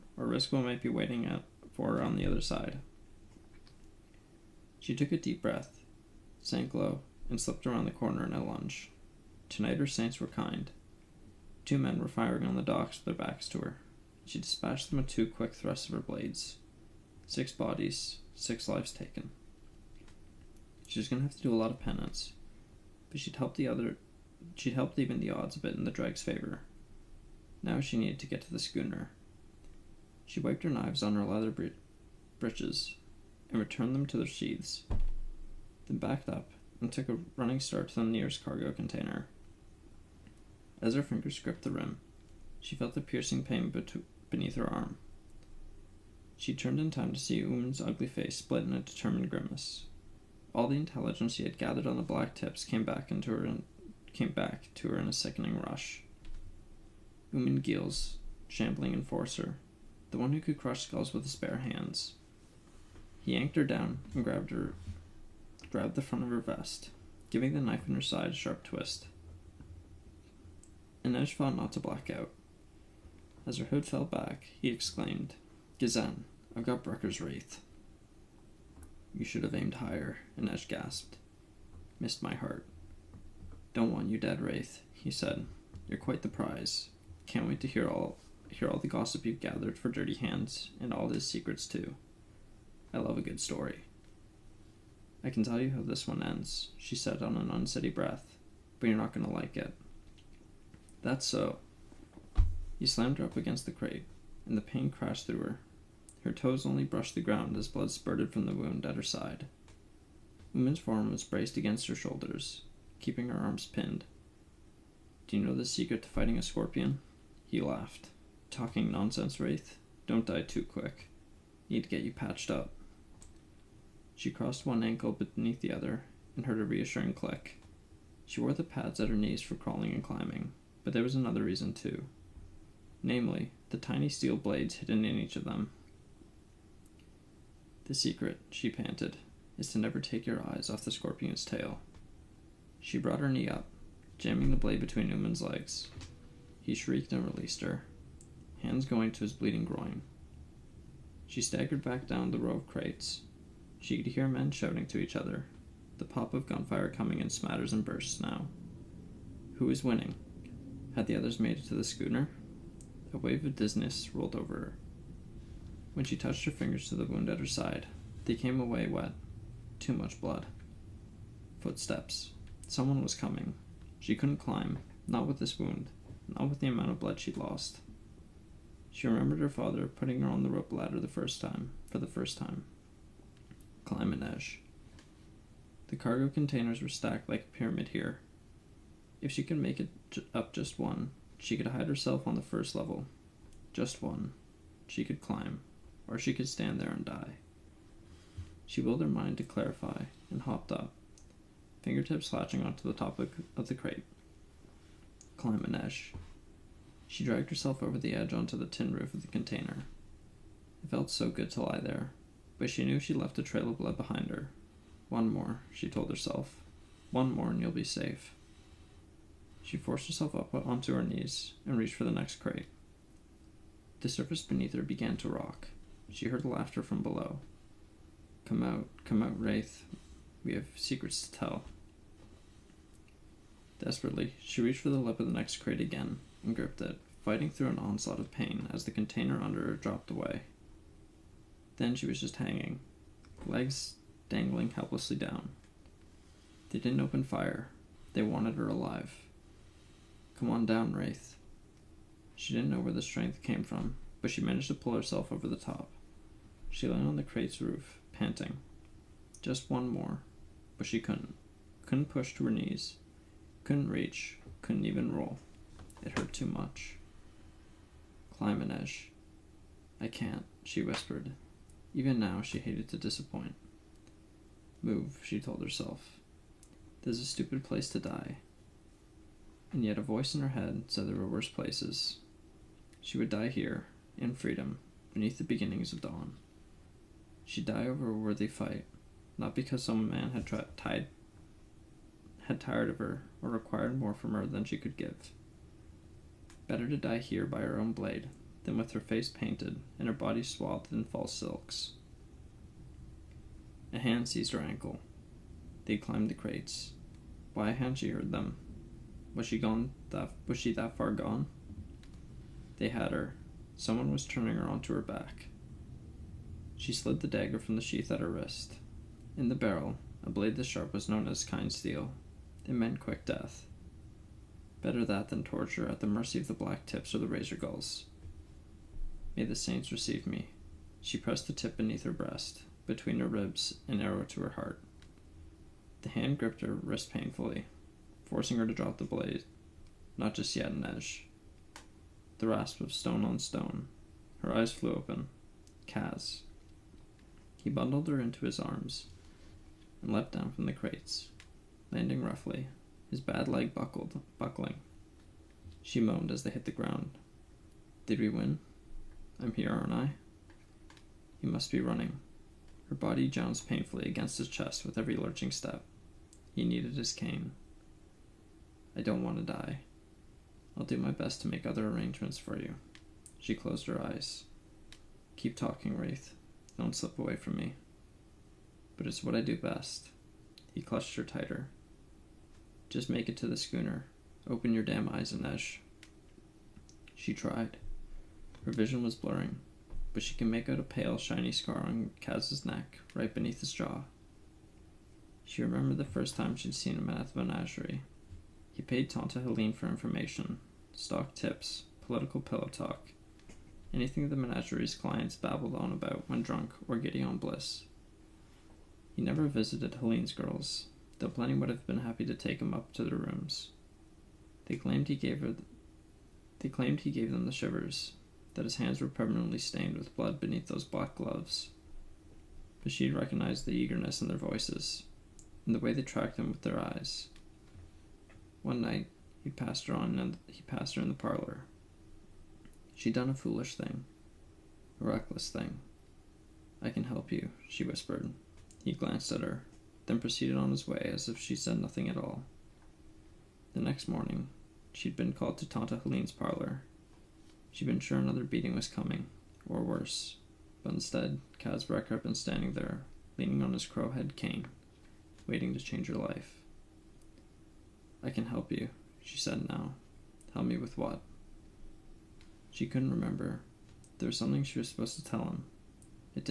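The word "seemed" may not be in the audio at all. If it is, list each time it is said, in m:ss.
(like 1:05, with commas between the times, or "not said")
not said.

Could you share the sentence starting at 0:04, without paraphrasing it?
She took a deep breath, sank low, and slipped around the corner in a lunge.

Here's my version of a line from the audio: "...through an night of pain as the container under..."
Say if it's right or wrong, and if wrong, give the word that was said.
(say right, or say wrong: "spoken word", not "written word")
wrong: "onslaught", not "night".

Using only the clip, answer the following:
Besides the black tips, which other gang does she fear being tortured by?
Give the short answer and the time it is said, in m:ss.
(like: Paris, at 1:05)
Razor gulls, at 5:27.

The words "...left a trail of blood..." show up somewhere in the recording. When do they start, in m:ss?
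3:33.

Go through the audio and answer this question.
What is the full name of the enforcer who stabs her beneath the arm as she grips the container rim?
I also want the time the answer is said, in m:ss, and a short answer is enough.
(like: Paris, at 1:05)
Oomen Geels, at 0:57.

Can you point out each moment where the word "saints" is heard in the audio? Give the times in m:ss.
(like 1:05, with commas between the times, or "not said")
0:09, 5:29.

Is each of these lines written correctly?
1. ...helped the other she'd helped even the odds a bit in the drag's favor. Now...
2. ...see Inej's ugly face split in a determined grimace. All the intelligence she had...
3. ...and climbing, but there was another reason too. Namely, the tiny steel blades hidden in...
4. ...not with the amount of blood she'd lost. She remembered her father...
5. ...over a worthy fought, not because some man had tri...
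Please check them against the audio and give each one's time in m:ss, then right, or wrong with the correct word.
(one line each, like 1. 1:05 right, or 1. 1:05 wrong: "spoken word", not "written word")
1. 0:23 right
2. 0:47 wrong: "Oomen", not "Inej"
3. 2:09 right
4. 2:56 right
5. 4:47 wrong: "fight", not "fought".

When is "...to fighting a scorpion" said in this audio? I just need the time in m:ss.
1:56.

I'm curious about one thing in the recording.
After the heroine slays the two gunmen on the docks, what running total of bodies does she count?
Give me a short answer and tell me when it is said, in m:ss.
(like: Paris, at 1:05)
6, at 0:17.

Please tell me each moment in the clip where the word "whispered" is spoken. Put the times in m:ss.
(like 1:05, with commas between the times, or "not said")
4:30, 7:17.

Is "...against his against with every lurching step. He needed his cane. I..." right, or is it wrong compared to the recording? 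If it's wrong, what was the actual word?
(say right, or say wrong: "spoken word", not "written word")
wrong: "chest", not "against".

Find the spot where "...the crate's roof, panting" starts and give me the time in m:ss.
4:17.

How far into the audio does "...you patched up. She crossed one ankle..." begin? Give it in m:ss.
2:02.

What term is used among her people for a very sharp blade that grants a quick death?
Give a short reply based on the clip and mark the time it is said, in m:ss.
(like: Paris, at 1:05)
Kind steel, at 5:21.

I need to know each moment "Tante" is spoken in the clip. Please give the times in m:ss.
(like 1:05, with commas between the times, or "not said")
6:39, 7:25.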